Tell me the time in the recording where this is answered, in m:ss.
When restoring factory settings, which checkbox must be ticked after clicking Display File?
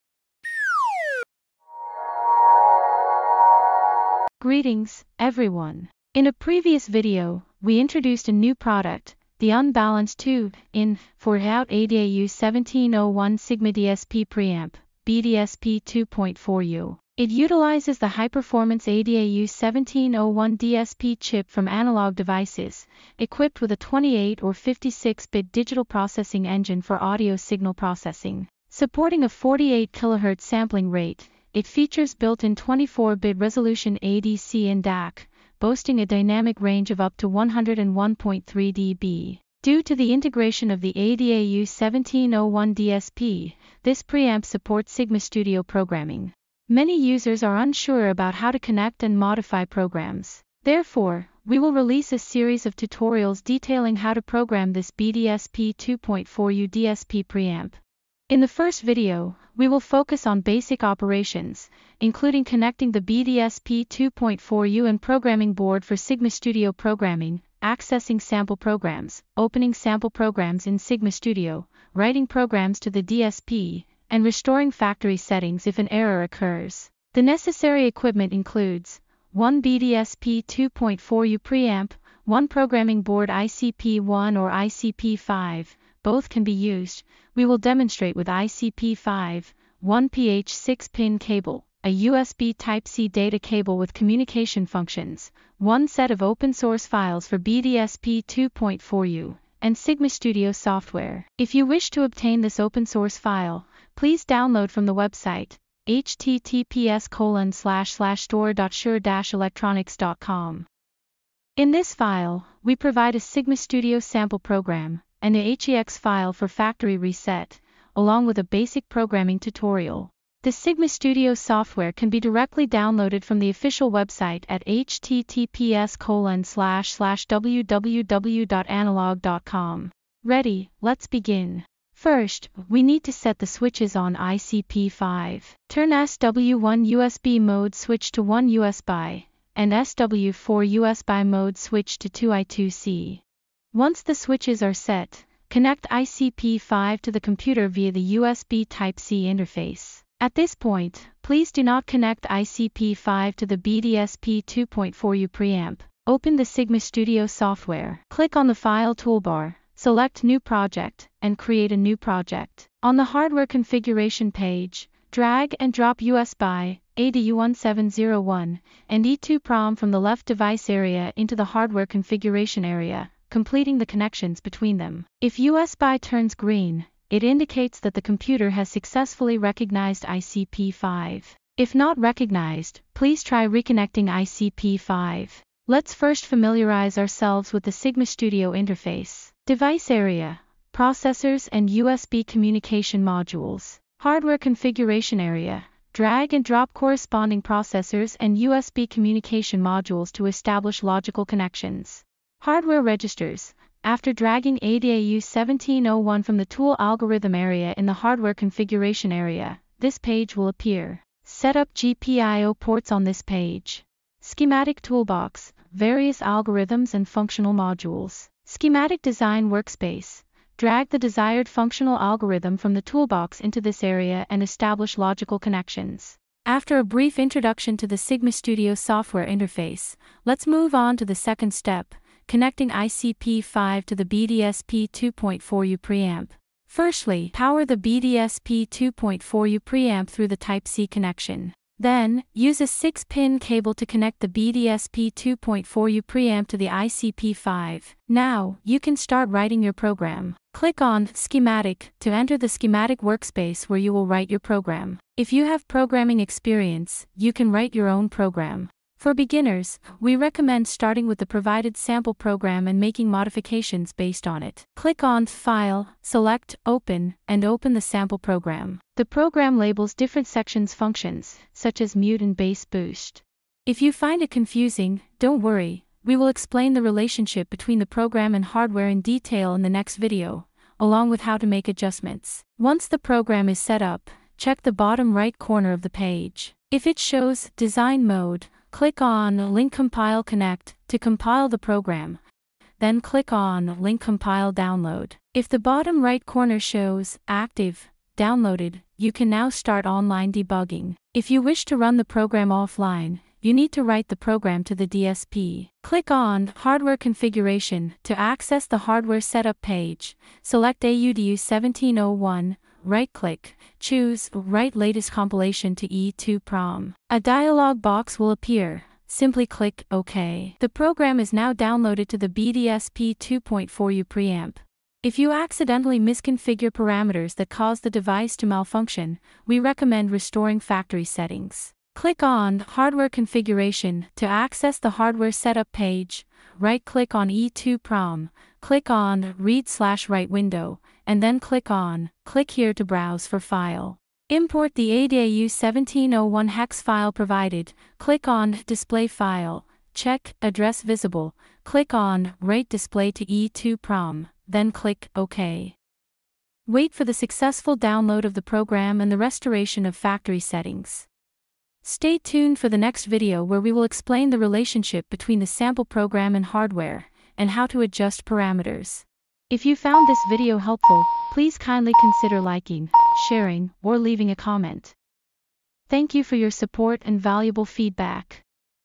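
5:50.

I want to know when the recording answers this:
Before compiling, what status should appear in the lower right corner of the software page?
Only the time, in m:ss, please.
4:47.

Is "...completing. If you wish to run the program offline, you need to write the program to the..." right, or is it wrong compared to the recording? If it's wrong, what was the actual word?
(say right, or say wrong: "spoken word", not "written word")
wrong: "debugging", not "completing".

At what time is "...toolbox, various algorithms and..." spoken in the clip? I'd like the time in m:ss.
3:34.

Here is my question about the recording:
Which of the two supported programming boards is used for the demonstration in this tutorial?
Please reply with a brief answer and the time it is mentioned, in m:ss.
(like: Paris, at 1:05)
ICP5, at 1:27.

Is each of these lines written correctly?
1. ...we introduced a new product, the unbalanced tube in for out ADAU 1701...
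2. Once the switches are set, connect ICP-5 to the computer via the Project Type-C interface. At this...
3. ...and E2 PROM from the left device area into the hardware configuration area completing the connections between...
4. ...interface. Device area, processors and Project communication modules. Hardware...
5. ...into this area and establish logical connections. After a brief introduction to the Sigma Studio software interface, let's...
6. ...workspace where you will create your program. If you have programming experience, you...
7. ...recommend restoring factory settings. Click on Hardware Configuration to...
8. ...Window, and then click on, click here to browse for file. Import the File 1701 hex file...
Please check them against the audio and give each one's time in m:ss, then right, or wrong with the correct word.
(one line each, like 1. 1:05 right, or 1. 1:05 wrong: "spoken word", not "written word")
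1. 0:07 right
2. 2:23 wrong: "USB", not "Project"
3. 2:48 right
4. 3:08 wrong: "USB", not "Project"
5. 3:43 right
6. 4:13 wrong: "write", not "create"
7. 5:29 right
8. 5:40 wrong: "ADAU", not "File".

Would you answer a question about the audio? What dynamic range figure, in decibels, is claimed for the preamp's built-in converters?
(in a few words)
101.3 dB.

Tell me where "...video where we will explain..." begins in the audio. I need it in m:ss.
6:03.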